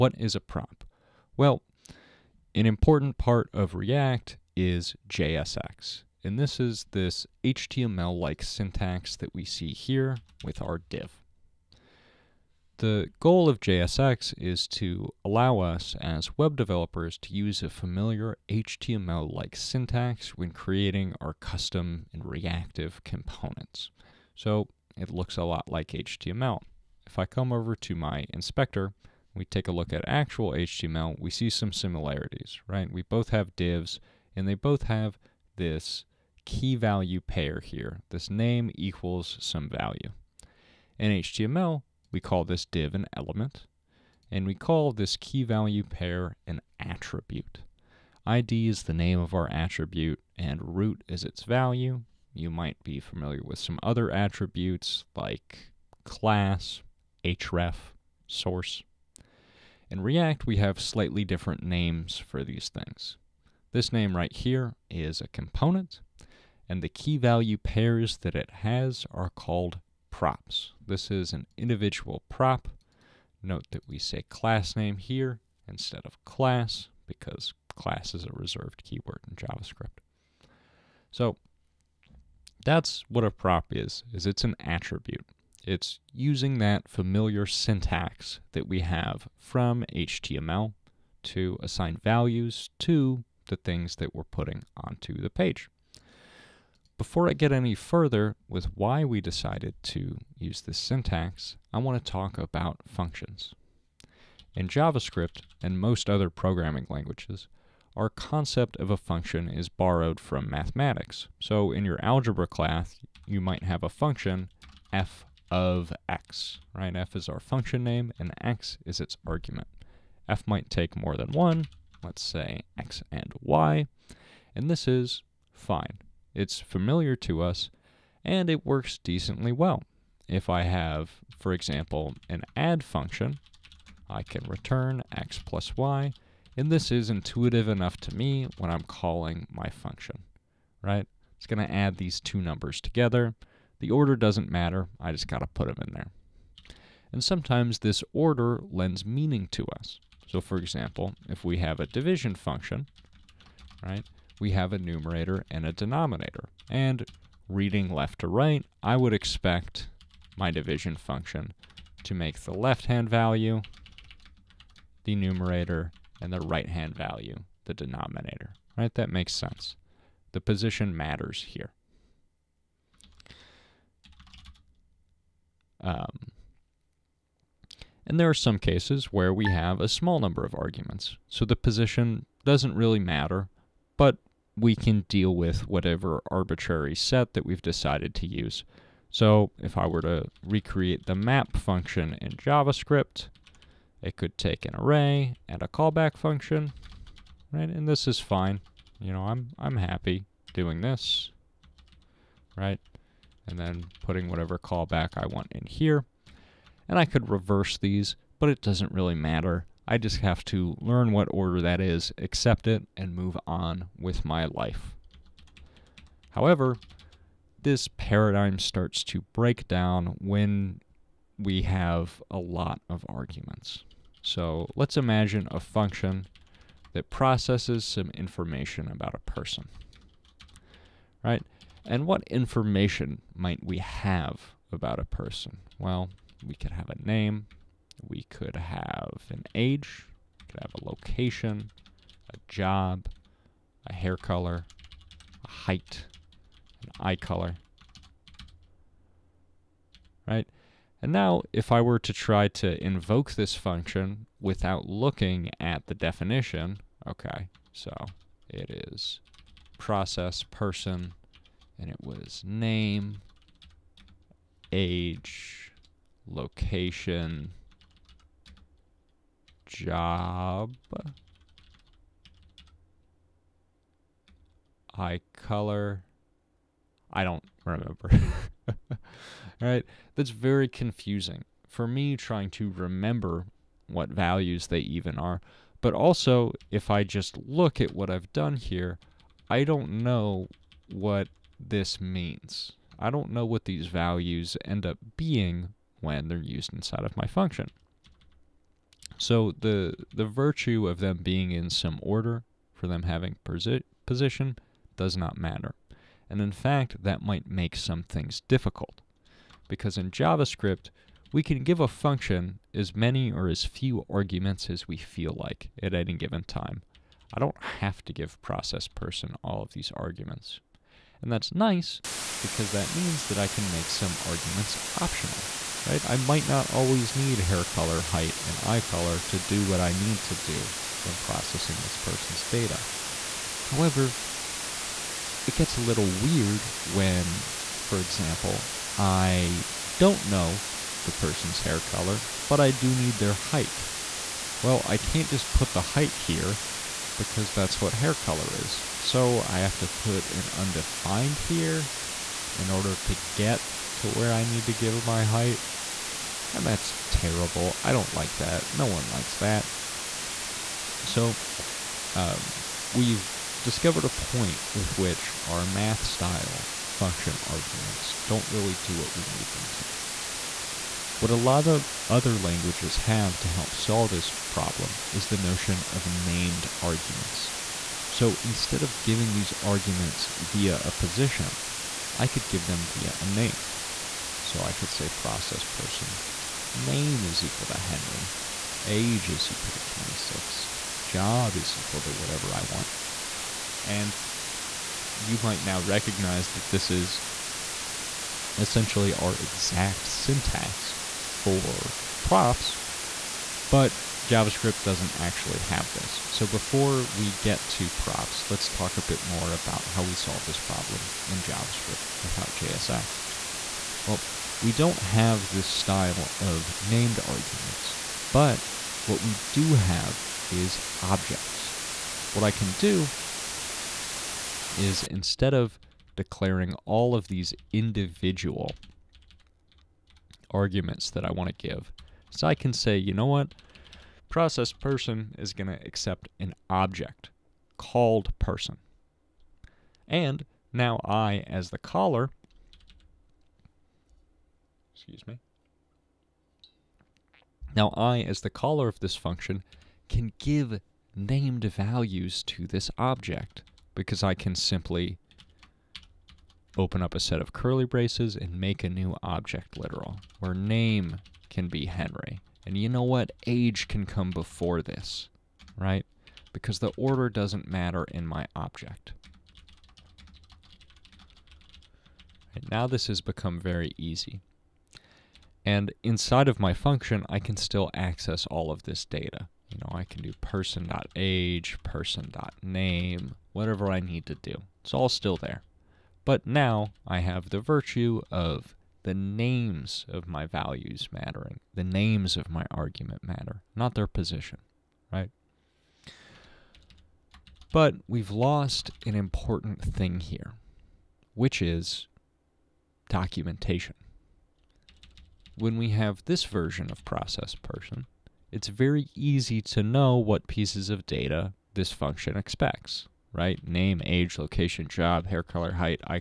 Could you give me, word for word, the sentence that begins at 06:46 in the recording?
So before we get to props, let's talk a bit more about how we solve this problem in JavaScript without JSX.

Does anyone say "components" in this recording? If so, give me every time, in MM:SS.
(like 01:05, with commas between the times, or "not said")
00:23, 01:05.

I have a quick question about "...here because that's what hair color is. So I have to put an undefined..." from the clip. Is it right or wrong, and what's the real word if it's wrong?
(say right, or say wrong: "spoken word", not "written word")
right.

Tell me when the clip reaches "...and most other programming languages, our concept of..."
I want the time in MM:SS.
01:45.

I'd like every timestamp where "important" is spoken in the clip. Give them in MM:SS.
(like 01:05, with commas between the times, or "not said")
00:02, 08:19.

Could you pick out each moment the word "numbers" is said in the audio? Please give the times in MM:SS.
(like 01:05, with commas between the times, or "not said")
02:22, 03:00.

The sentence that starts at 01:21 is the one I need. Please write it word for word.
So that's what a prop is, is it's an attribute.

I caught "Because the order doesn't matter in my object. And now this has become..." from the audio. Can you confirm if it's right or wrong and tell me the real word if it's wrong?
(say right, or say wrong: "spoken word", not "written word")
right.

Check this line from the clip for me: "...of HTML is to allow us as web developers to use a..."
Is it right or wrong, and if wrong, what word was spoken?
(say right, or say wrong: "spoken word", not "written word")
wrong: "JSX", not "HTML".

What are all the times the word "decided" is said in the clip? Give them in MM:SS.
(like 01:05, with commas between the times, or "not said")
01:39, 03:07.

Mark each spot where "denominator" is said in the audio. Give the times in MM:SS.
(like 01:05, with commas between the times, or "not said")
02:35, 02:47.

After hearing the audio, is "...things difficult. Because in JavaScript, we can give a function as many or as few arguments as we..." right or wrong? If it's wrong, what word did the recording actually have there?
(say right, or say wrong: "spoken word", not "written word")
right.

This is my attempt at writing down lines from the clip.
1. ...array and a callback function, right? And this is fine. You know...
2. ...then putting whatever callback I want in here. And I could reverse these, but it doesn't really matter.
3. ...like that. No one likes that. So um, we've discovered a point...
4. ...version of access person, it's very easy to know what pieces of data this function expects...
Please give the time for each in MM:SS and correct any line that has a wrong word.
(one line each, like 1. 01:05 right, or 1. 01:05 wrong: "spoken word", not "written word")
1. 03:14 right
2. 03:23 right
3. 05:58 right
4. 08:26 wrong: "process", not "access".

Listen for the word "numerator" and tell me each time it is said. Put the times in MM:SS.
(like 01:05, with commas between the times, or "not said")
02:34, 02:45.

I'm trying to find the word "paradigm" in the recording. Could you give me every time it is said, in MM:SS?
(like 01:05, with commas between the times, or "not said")
03:37.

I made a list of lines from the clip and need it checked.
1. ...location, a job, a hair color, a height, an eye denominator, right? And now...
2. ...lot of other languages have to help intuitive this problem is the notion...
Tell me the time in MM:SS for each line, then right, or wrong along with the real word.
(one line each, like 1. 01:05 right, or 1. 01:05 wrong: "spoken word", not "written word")
1. 04:00 wrong: "color", not "denominator"
2. 06:11 wrong: "solve", not "intuitive".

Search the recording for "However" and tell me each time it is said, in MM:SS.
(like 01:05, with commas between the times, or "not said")
03:36, 05:33.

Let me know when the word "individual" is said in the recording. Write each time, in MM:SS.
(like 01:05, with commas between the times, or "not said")
01:11, 07:07.